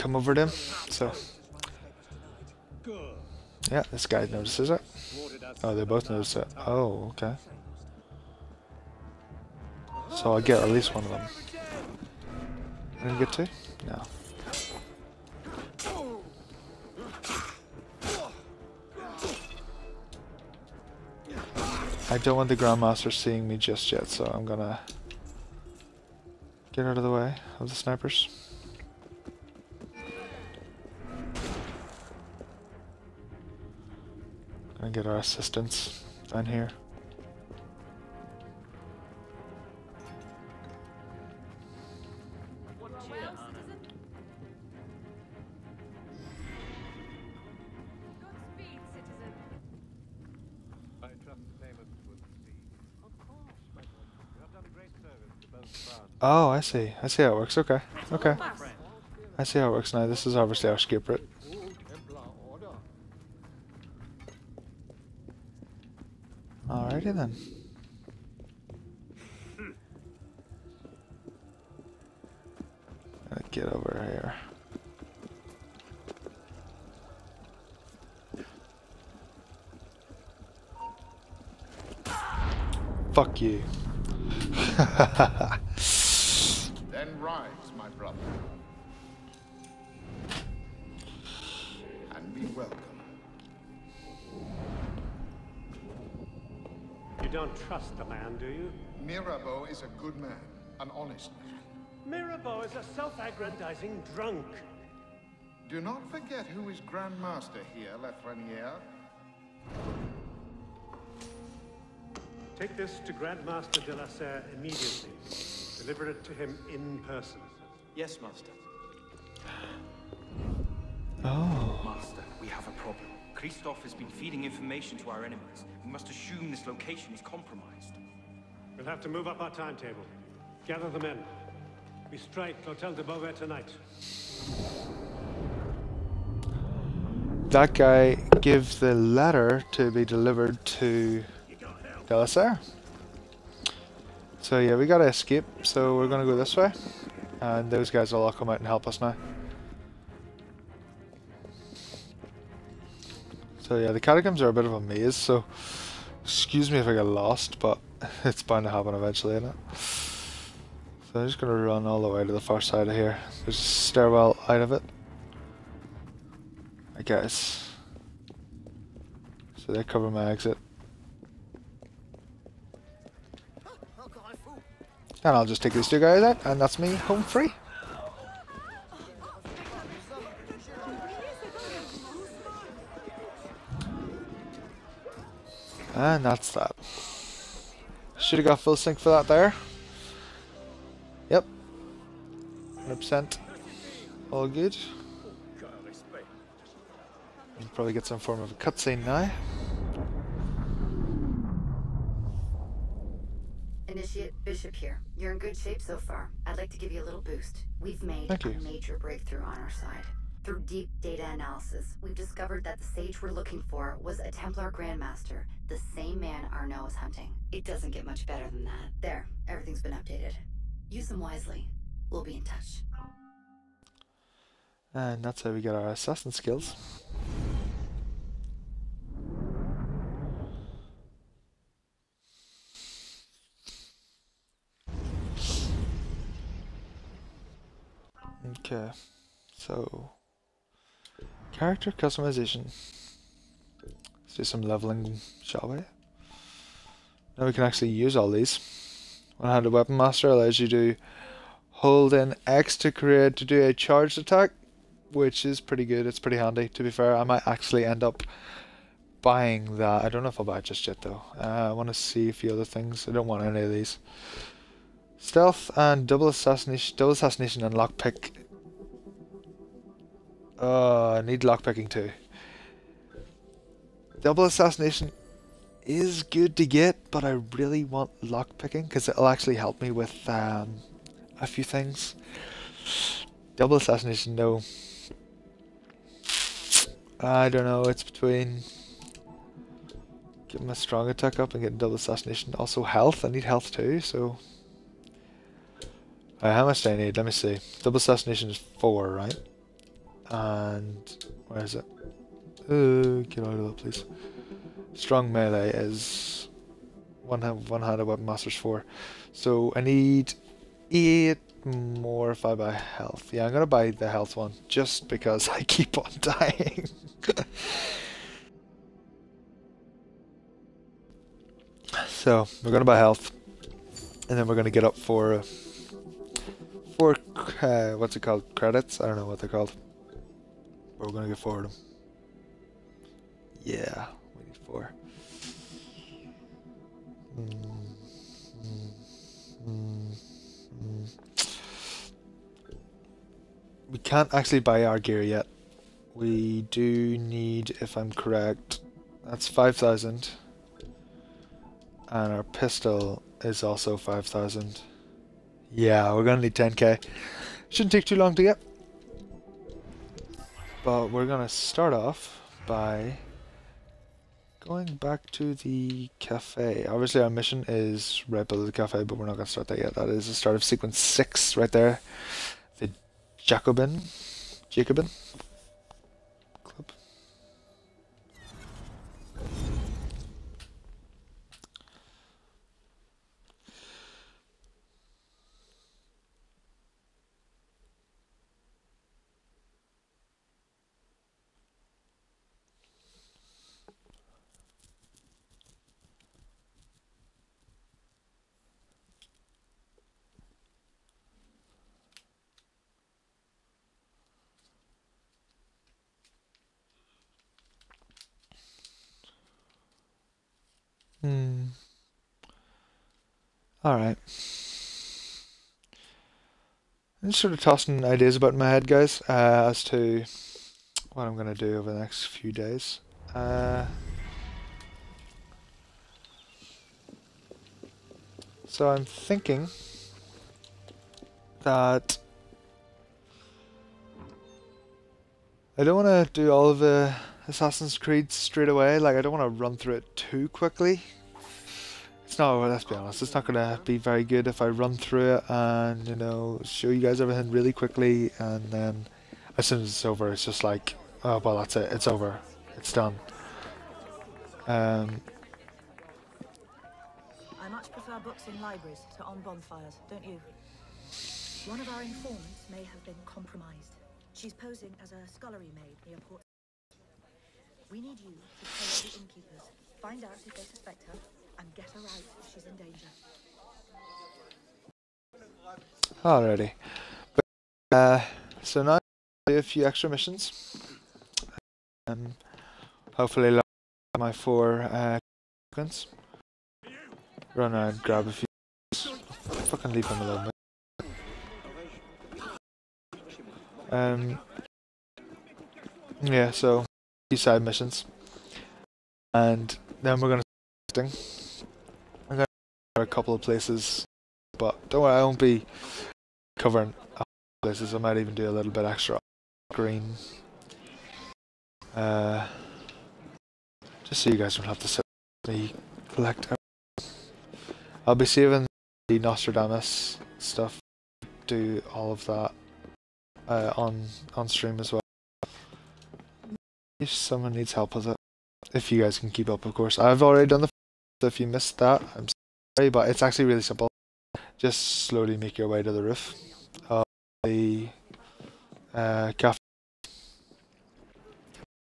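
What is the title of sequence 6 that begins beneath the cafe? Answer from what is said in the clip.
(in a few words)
The Jacobin.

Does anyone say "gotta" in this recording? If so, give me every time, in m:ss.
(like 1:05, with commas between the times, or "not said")
1:13, 2:24.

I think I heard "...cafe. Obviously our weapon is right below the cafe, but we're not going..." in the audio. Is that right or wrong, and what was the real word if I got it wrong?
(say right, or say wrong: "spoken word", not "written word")
wrong: "mission", not "weapon".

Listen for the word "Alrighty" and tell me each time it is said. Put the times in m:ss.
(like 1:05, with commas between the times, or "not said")
1:06, 7:56.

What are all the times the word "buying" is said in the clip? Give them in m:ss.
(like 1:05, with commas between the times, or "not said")
4:19.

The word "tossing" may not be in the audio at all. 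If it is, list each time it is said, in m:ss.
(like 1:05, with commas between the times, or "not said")
6:57.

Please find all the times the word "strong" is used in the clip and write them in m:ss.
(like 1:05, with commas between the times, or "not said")
4:50, 5:04.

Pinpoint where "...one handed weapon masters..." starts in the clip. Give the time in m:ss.
5:07.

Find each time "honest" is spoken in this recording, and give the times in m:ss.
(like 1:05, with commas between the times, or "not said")
1:40, 7:22.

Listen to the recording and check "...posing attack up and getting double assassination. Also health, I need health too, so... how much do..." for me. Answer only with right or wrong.
wrong.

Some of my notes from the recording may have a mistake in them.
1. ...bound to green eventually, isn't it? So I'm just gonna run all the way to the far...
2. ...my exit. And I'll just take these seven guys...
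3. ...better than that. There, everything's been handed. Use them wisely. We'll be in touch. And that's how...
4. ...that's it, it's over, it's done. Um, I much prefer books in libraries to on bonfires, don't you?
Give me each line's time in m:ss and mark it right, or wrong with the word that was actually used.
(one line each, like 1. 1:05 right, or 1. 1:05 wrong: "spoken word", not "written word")
1. 2:38 wrong: "happen", not "green"
2. 2:50 wrong: "two", not "seven"
3. 3:38 wrong: "updated", not "handed"
4. 7:31 right.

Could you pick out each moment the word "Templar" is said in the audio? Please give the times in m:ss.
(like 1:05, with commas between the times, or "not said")
3:34.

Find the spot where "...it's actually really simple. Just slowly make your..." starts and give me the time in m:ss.
8:53.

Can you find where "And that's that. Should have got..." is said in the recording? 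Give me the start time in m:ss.
3:05.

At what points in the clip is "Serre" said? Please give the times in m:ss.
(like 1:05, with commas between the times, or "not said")
1:54, 2:22.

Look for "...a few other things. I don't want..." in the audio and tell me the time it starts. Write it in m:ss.
4:22.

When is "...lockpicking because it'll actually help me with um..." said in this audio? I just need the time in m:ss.
4:38.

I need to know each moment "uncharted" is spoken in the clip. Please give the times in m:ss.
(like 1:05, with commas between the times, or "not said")
not said.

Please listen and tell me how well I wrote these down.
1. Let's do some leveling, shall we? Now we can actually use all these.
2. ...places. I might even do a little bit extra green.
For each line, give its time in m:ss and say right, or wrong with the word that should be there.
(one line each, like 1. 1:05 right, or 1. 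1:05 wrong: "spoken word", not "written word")
1. 4:03 right
2. 8:27 right.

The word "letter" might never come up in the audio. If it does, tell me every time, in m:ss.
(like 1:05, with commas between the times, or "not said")
2:18.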